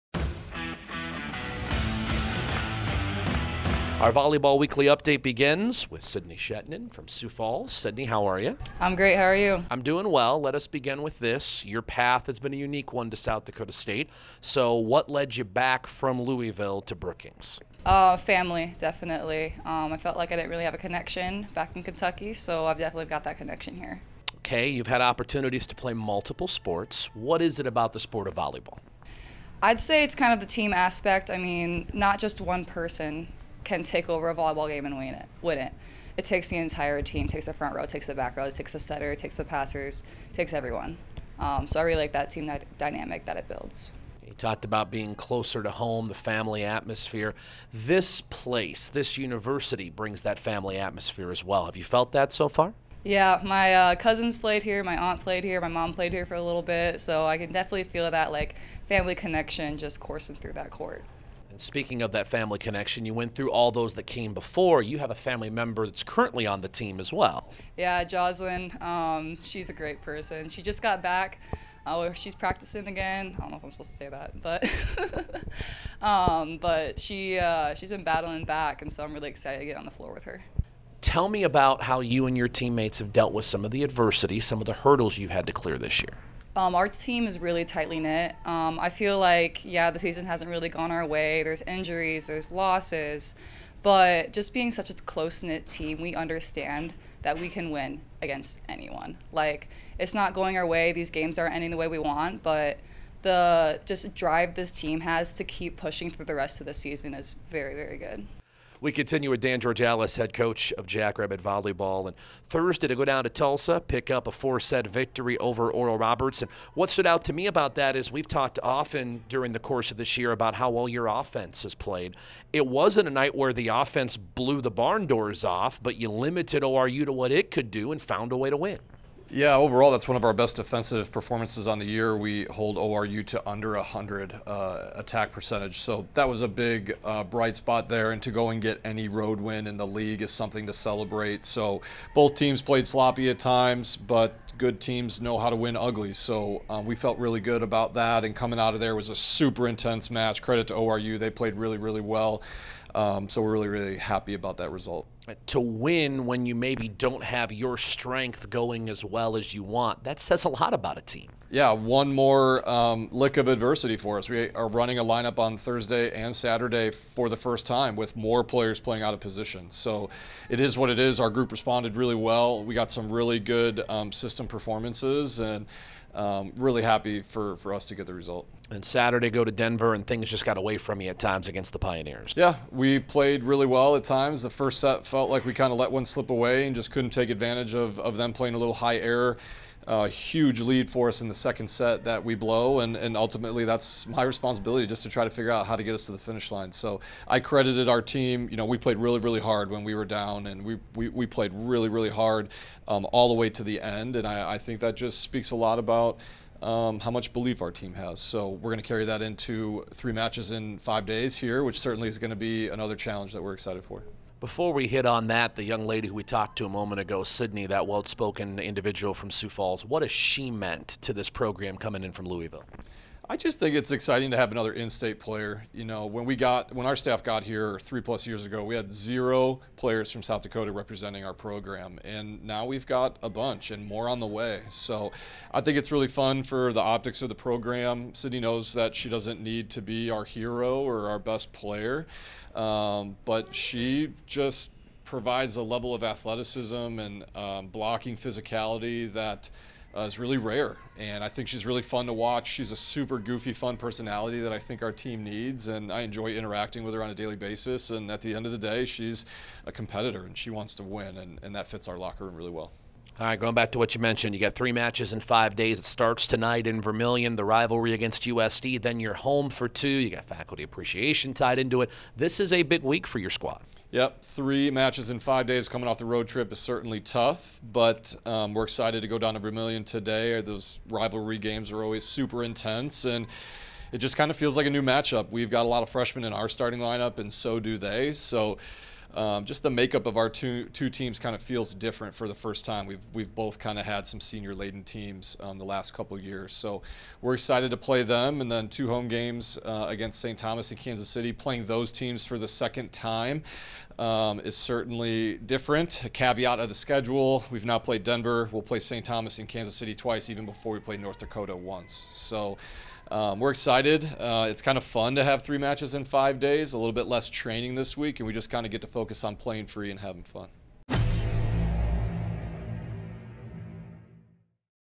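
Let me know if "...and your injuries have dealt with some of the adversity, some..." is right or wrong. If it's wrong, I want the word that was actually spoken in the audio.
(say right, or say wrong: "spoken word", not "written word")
wrong: "teammates", not "injuries".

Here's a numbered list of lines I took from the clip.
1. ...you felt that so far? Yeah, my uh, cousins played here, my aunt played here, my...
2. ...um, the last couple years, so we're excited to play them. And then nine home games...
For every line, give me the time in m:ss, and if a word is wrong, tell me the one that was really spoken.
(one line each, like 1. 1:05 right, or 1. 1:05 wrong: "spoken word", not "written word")
1. 0:51 right
2. 4:55 wrong: "two", not "nine".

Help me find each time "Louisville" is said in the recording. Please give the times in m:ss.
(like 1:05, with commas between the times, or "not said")
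0:16, 3:42.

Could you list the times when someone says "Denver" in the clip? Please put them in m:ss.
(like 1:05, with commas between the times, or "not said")
2:59, 5:08.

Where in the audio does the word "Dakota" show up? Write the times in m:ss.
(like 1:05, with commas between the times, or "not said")
0:13, 3:50, 5:11.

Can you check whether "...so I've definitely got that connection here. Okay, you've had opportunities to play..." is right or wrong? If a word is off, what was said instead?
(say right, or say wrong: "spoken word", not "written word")
right.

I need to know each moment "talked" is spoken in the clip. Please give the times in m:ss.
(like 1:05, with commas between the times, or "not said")
0:44, 1:58, 3:36.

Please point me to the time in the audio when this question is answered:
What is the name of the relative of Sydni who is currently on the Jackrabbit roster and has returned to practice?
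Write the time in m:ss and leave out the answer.
1:08.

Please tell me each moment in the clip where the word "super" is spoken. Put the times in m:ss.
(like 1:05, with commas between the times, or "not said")
2:29, 4:12, 4:42.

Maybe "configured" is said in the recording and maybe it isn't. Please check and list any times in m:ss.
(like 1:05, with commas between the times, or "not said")
not said.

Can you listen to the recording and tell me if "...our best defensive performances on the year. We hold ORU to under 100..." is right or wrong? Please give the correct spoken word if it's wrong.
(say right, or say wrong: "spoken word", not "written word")
right.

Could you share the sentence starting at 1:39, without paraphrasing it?
Like, it's not going our way.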